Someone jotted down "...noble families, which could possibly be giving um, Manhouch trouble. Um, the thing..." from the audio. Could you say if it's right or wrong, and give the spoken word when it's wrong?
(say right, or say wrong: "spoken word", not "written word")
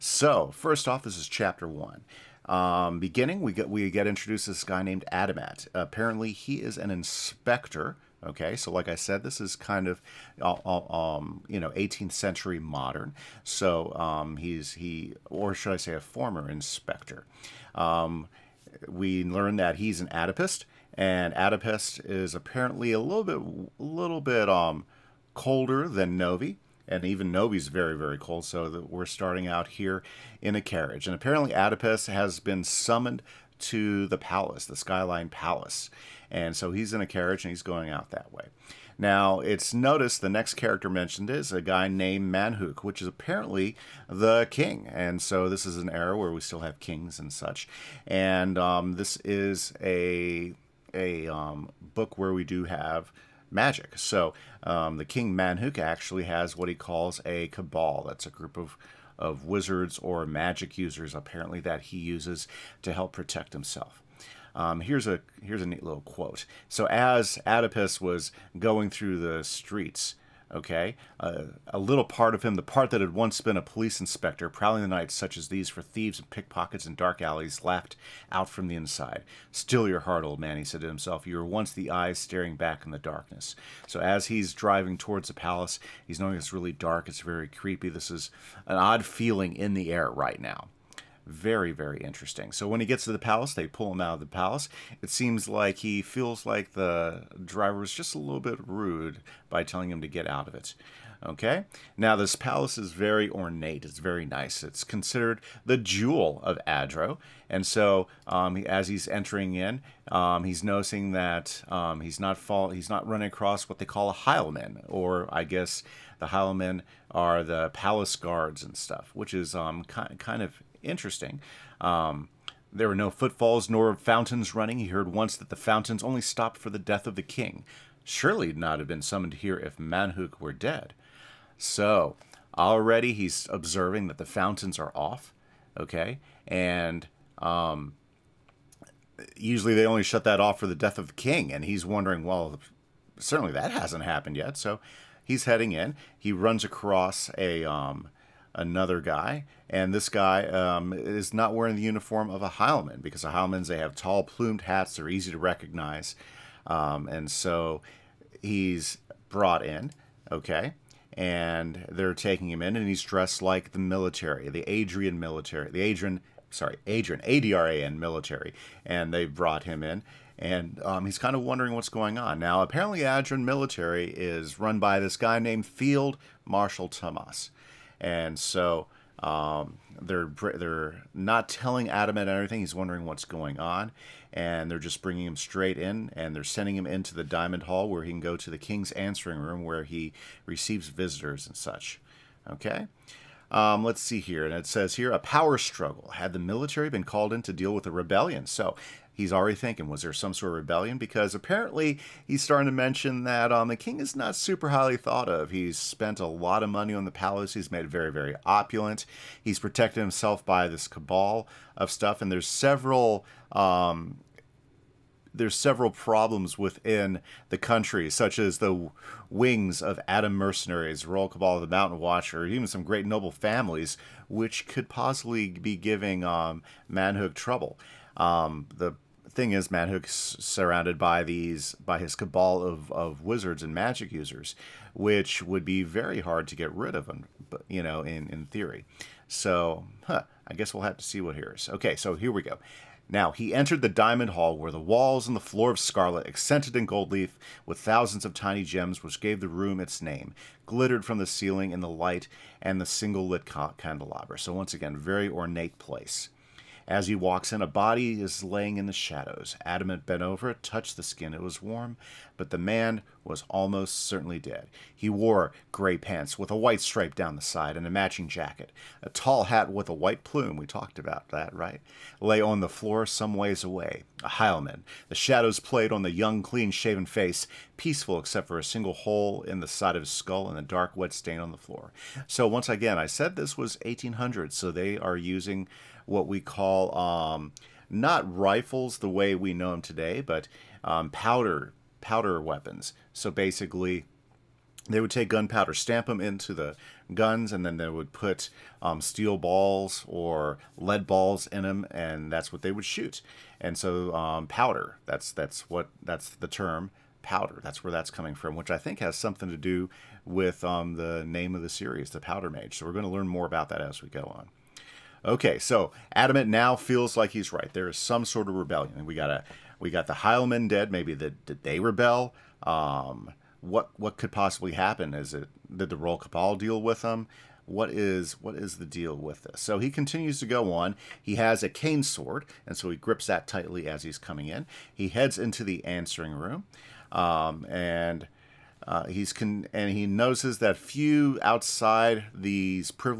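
right.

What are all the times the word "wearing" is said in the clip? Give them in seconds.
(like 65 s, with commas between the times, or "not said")
151 s.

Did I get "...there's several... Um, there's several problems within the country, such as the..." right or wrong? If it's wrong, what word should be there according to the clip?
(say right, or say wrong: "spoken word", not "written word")
right.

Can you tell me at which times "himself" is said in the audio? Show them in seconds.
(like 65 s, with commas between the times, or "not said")
63 s, 80 s, 210 s.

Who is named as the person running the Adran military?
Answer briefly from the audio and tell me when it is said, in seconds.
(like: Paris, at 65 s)
Field Marshal Tomas, at 175 s.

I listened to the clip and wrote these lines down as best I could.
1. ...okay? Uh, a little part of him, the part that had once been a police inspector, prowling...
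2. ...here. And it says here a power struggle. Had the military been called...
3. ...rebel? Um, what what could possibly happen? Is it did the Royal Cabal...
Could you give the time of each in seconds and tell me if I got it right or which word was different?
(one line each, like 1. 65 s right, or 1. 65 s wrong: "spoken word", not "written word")
1. 70 s right
2. 194 s right
3. 321 s right.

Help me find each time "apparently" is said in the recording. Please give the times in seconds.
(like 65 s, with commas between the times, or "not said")
5 s, 22 s, 31 s, 43 s, 61 s, 172 s, 201 s.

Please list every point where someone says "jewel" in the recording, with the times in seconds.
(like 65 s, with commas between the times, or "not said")
105 s.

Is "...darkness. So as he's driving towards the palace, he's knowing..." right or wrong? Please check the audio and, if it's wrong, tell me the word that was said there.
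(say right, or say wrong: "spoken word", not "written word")
right.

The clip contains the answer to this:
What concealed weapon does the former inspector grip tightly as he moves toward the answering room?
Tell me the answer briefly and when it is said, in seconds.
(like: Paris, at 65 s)
cane sword, at 331 s.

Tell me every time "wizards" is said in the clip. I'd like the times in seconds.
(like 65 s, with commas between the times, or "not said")
59 s, 233 s.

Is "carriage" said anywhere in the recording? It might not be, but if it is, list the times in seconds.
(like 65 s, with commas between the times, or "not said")
30 s, 37 s.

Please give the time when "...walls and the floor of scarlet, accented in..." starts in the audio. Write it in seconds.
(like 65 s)
244 s.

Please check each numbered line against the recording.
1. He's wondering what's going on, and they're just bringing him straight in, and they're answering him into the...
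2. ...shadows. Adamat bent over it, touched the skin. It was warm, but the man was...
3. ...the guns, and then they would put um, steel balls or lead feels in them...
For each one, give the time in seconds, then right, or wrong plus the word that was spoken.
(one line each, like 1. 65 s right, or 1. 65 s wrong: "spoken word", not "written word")
1. 182 s wrong: "sending", not "answering"
2. 258 s right
3. 296 s wrong: "balls", not "feels".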